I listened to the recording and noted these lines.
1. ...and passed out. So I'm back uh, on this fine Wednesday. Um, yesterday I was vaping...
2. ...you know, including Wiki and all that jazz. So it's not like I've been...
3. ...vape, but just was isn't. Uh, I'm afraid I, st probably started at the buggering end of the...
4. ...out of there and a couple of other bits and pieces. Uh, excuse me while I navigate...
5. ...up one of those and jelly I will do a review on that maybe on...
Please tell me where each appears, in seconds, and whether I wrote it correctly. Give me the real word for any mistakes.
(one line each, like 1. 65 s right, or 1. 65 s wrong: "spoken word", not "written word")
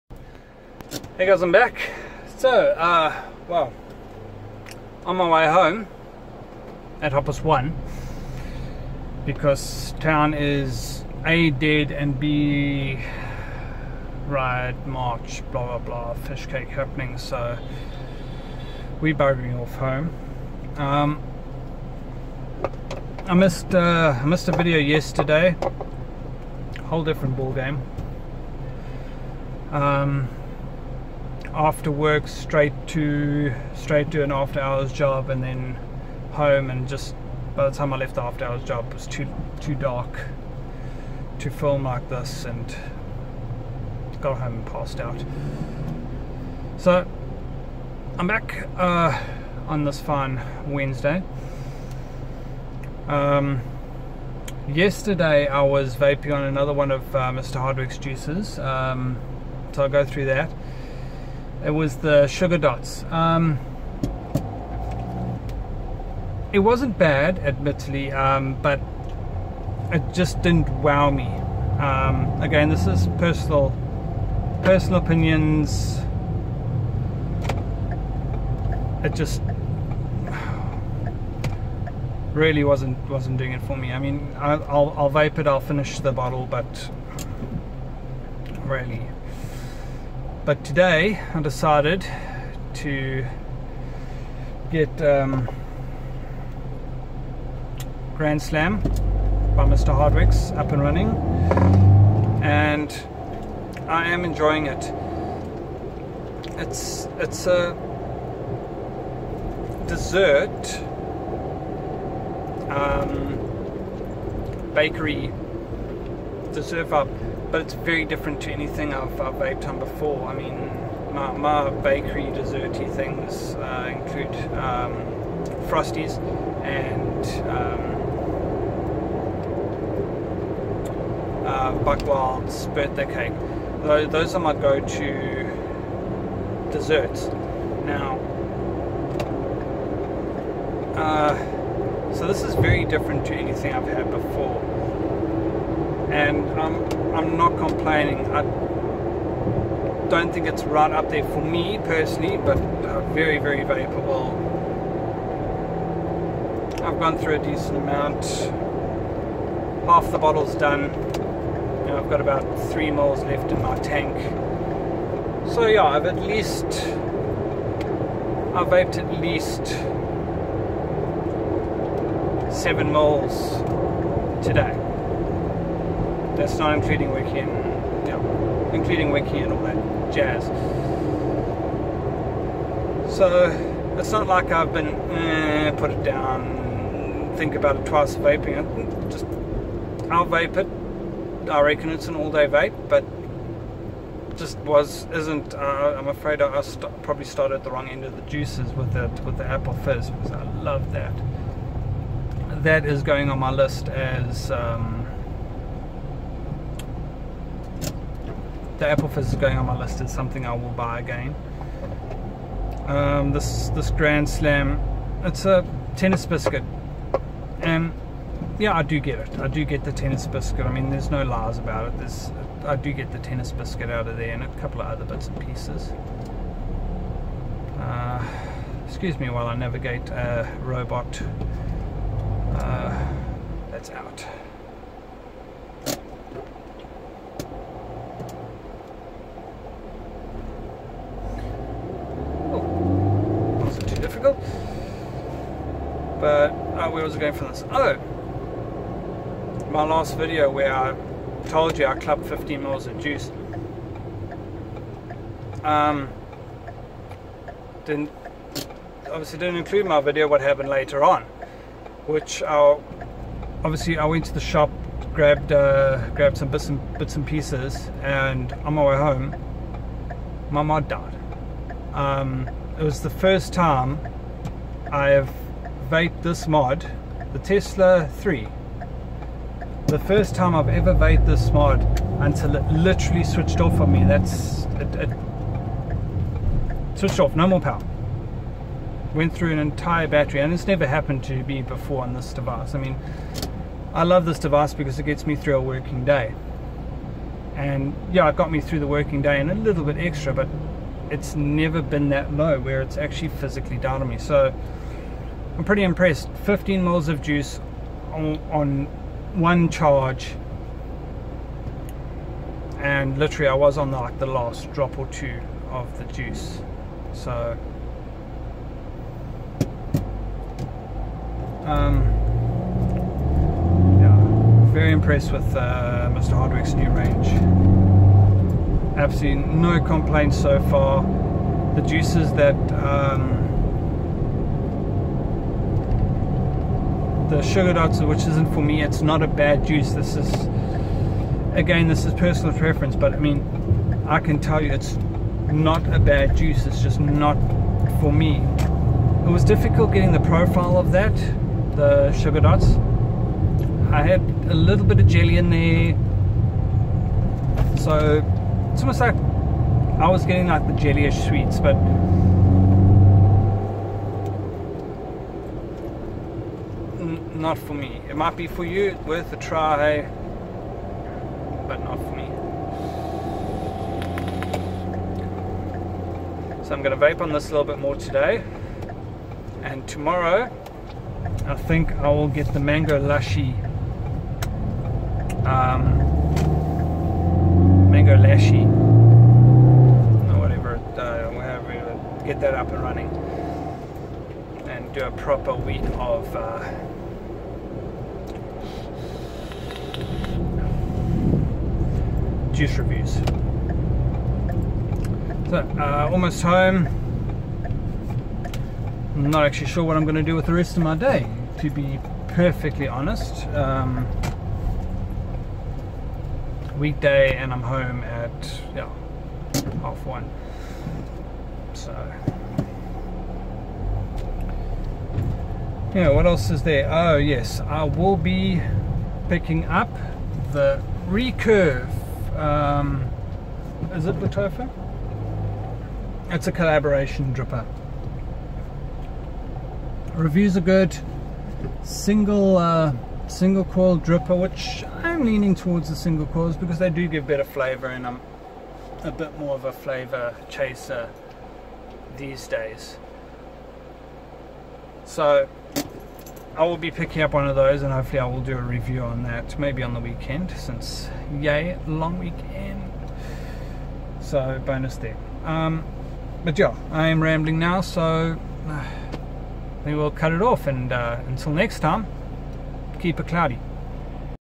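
1. 44 s right
2. 178 s right
3. 192 s wrong: "wrong", not "buggering"
4. 223 s right
5. 457 s wrong: "hopefully", not "jelly".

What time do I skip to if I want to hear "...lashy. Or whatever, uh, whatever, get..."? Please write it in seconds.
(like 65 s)
388 s.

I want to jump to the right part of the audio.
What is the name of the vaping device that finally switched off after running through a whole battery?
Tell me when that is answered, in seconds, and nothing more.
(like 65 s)
277 s.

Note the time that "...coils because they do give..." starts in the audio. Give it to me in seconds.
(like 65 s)
446 s.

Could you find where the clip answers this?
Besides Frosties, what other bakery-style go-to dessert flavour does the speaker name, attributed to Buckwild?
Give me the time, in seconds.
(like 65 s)
132 s.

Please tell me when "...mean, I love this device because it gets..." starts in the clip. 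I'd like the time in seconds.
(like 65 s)
292 s.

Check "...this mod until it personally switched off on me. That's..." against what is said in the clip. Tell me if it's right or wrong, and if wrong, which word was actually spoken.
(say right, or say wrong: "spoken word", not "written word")
wrong: "literally", not "personally".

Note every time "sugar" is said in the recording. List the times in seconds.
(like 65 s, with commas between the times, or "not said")
62 s, 337 s, 352 s.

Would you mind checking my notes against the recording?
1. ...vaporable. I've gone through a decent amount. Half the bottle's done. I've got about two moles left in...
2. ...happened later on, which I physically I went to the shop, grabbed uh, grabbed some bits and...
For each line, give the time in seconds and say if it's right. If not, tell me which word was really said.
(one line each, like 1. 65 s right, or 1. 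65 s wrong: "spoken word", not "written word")
1. 153 s wrong: "three", not "two"
2. 260 s wrong: "obviously", not "physically".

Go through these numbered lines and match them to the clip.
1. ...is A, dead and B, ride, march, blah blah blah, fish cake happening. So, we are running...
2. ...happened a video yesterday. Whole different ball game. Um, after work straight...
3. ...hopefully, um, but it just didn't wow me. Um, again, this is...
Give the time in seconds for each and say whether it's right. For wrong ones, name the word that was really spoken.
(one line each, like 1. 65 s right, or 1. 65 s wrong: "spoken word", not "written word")
1. 10 s wrong: "buggering", not "running"
2. 24 s wrong: "missed", not "happened"
3. 67 s wrong: "admittedly", not "hopefully".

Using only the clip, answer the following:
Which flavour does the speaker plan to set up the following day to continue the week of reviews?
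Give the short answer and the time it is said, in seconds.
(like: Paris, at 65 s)
mango lushy, at 382 s.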